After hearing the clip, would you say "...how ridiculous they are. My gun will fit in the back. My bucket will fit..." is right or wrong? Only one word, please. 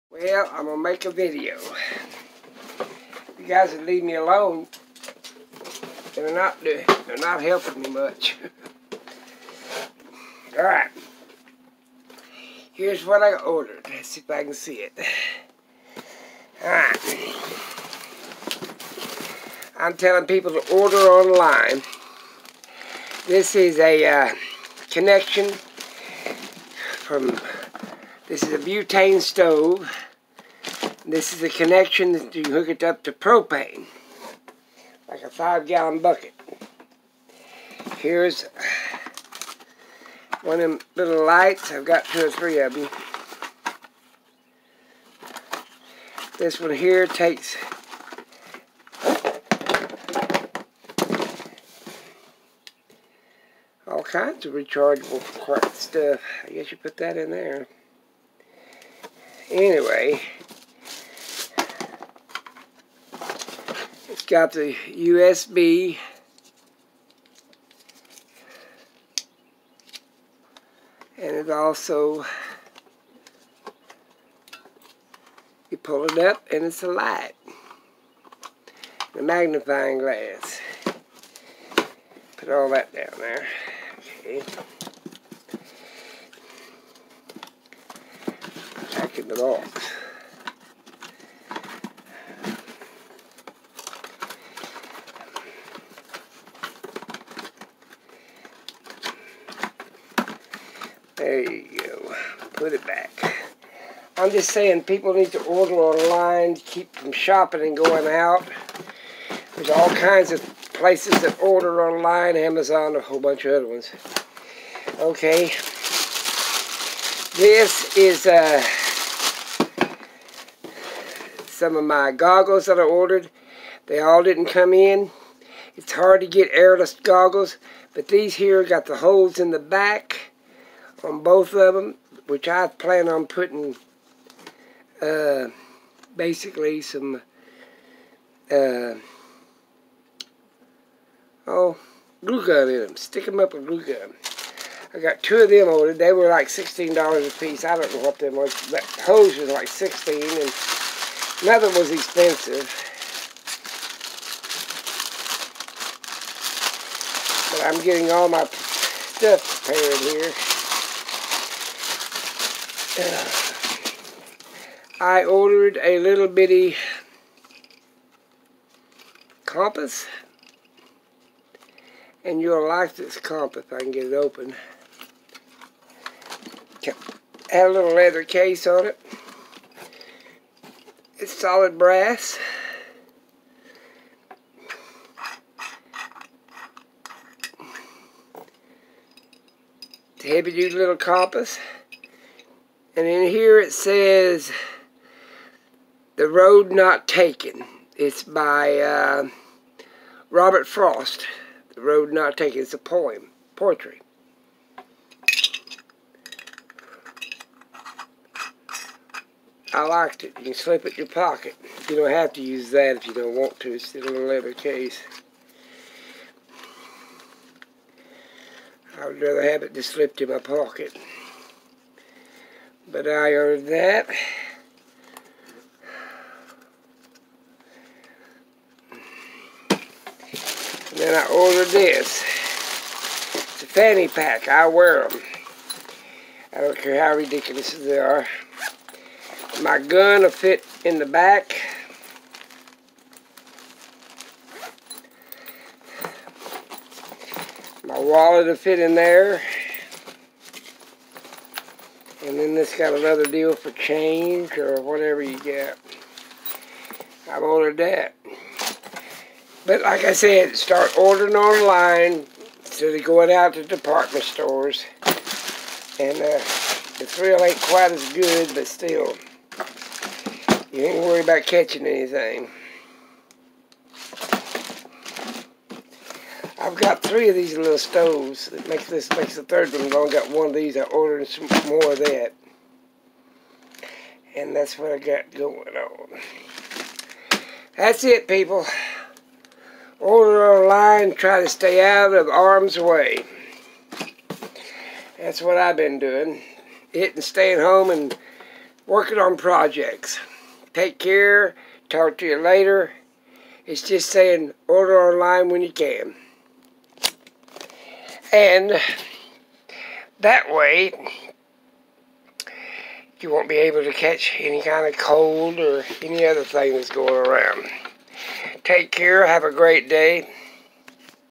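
wrong.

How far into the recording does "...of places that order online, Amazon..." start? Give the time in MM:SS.
01:50.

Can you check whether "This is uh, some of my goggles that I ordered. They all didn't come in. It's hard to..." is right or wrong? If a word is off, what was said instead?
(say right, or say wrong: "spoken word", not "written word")
right.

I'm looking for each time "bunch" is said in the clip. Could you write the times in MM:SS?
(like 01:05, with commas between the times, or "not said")
01:53.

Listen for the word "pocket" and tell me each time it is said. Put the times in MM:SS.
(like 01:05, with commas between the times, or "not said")
03:31, 03:40.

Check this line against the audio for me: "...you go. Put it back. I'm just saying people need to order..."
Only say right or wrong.
right.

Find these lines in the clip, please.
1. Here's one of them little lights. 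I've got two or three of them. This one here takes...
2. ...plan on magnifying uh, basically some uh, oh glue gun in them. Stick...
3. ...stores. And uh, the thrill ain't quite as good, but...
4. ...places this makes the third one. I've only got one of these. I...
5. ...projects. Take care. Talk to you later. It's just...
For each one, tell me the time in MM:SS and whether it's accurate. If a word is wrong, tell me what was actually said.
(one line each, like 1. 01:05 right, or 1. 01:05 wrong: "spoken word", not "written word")
1. 00:37 right
2. 02:12 wrong: "putting", not "magnifying"
3. 04:24 right
4. 04:38 wrong: "makes", not "places"
5. 04:59 right.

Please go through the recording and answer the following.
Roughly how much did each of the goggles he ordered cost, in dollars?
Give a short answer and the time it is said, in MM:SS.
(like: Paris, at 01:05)
16, at 02:26.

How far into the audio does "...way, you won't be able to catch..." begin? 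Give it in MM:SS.
05:10.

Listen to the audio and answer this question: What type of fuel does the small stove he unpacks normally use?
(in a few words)
Butane.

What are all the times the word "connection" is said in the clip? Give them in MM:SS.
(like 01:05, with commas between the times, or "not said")
00:24, 00:31.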